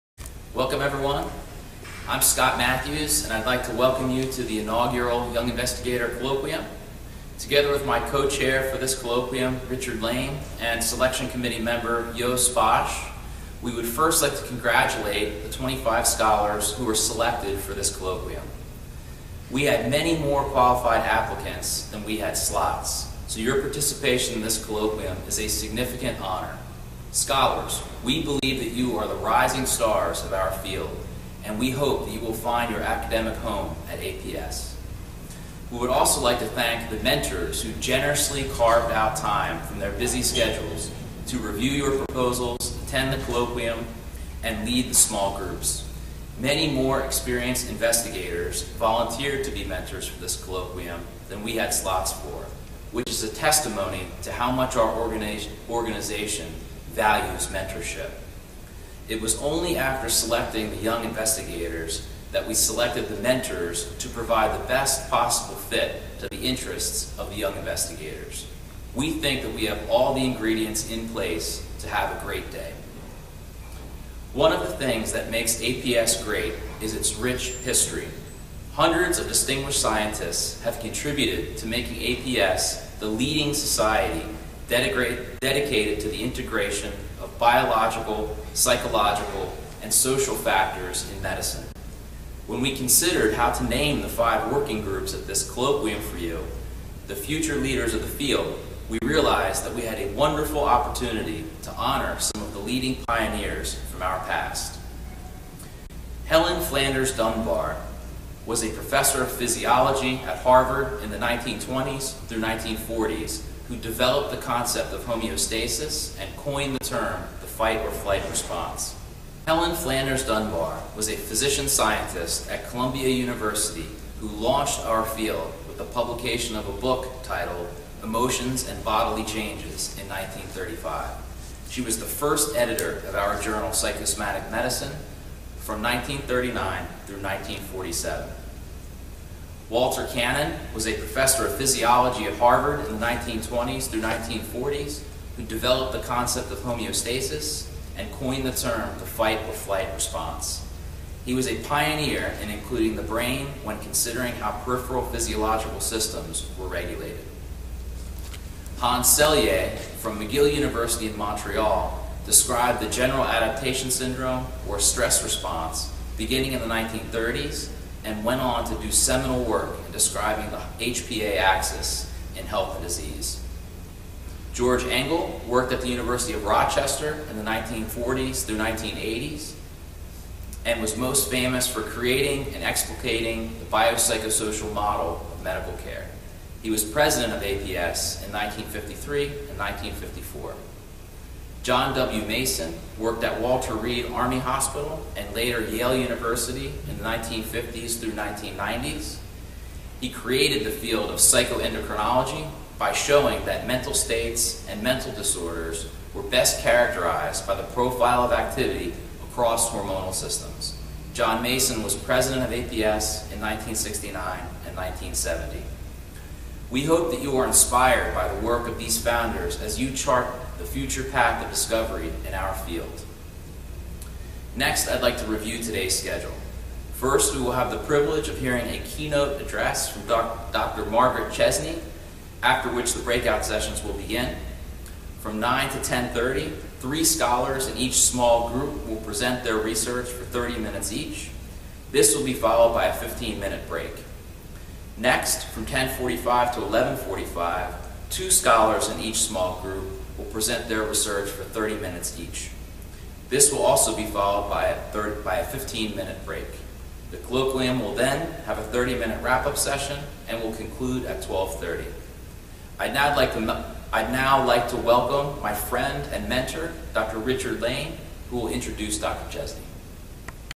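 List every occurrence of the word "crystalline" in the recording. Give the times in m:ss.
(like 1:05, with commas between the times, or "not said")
not said.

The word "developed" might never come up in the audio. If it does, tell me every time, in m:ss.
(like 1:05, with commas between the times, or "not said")
1:53, 2:25.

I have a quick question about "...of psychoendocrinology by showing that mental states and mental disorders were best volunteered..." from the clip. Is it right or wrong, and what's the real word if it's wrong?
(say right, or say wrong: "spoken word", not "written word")
wrong: "characterized", not "volunteered".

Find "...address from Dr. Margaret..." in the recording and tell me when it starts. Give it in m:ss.
3:49.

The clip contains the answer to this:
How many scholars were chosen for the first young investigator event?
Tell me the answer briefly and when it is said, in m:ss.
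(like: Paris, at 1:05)
25, at 0:15.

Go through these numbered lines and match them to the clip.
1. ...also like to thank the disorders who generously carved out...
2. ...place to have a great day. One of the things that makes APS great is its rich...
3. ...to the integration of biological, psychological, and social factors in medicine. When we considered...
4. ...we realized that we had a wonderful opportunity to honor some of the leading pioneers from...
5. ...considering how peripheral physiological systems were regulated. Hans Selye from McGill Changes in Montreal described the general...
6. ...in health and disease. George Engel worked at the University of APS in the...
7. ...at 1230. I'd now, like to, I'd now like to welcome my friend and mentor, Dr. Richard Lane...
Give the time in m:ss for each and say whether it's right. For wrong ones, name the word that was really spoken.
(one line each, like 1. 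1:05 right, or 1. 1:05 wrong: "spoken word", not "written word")
1. 0:35 wrong: "mentors", not "disorders"
2. 1:11 right
3. 1:25 right
4. 1:38 right
5. 2:33 wrong: "University", not "Changes"
6. 2:52 wrong: "Rochester", not "APS"
7. 4:21 right.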